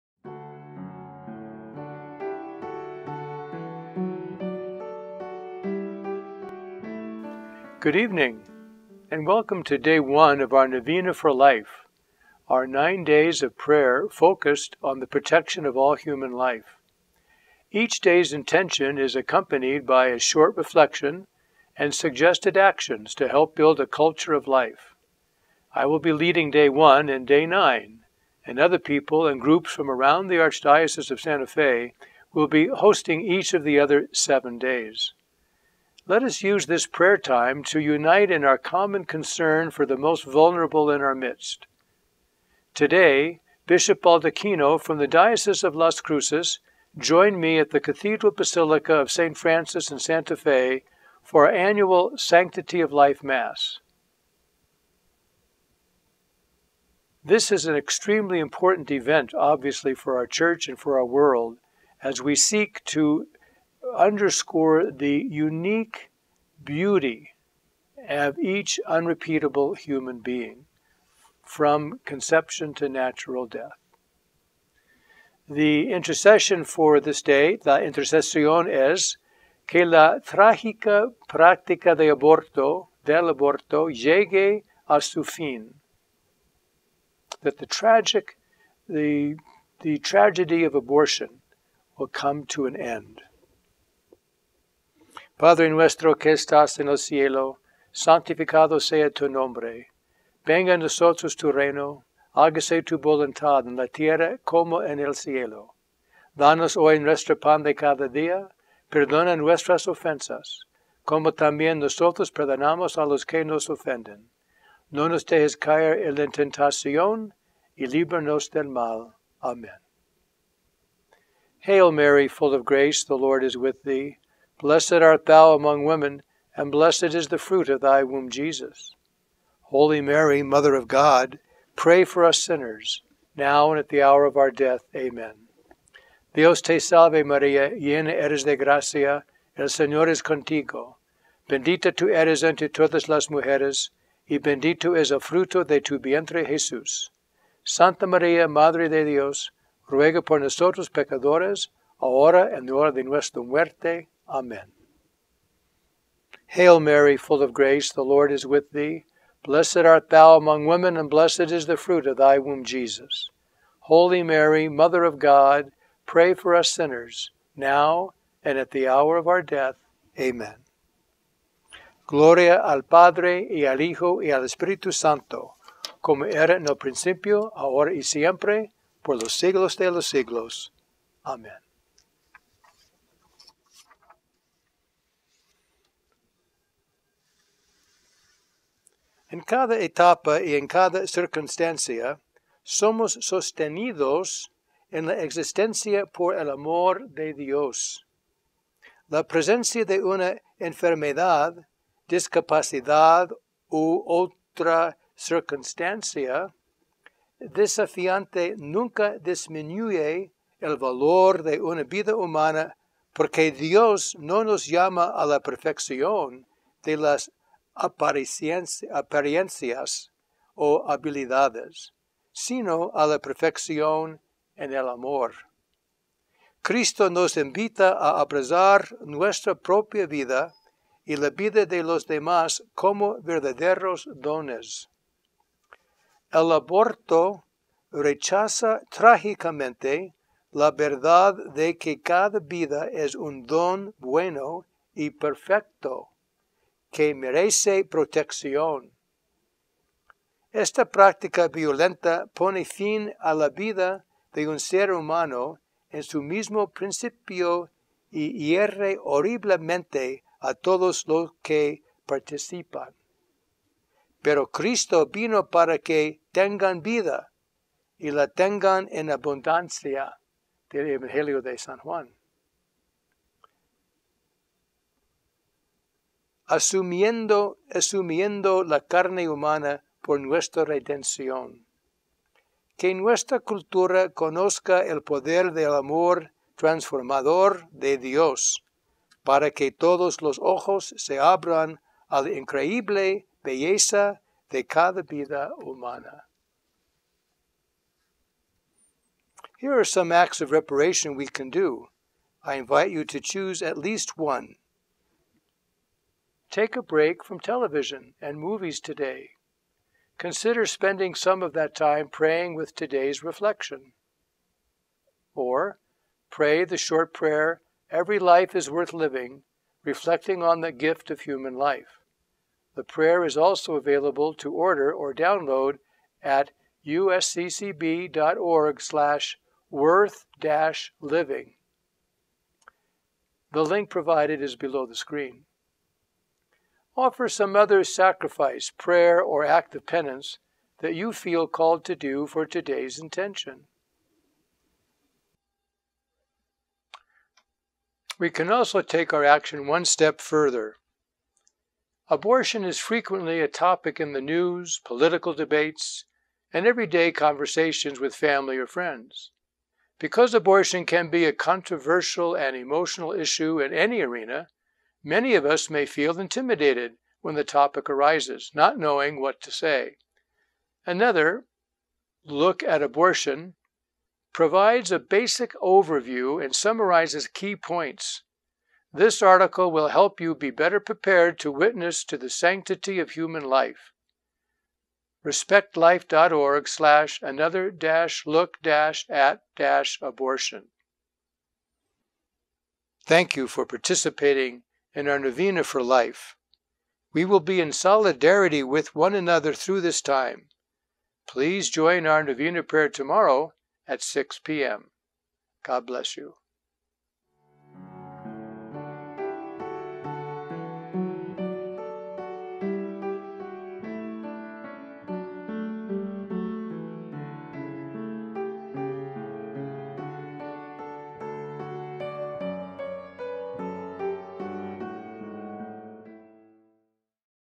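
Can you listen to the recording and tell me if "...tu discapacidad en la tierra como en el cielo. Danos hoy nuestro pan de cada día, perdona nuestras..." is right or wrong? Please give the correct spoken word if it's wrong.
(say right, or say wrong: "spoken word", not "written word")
wrong: "voluntad", not "discapacidad".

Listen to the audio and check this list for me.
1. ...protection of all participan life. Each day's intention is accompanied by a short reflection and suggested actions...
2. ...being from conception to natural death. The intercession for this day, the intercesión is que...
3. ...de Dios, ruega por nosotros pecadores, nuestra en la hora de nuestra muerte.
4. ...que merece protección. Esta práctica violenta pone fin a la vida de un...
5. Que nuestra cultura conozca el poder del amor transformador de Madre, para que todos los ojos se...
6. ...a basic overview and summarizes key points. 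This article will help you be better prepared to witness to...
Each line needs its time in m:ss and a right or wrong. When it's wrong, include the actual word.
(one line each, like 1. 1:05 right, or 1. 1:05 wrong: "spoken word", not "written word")
1. 0:15 wrong: "human", not "participan"
2. 1:10 right
3. 2:28 wrong: "ahora", not "nuestra"
4. 4:06 right
5. 4:42 wrong: "Dios", not "Madre"
6. 6:14 right.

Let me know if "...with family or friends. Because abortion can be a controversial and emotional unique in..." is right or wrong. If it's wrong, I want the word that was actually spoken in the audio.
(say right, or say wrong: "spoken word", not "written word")
wrong: "issue", not "unique".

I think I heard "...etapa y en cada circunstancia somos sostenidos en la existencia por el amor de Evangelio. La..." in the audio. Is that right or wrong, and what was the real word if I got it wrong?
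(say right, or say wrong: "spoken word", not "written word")
wrong: "Dios", not "Evangelio".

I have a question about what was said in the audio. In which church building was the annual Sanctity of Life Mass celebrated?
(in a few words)
Cathedral Basilica of St. Francis.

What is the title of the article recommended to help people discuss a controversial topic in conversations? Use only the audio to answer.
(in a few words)
Another Look at Abortion.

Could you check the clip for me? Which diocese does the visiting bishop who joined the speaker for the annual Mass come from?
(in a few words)
Diocese of Las Cruces.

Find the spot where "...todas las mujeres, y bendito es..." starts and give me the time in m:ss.
2:22.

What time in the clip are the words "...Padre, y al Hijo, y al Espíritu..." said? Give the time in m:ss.
2:52.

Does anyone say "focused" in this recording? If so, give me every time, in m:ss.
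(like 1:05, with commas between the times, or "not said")
0:14.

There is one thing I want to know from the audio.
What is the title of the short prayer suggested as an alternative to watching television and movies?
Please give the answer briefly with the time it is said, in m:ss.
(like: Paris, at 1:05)
Every Life is Worth Living, at 5:17.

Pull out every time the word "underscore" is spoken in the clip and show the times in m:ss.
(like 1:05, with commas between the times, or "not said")
1:03.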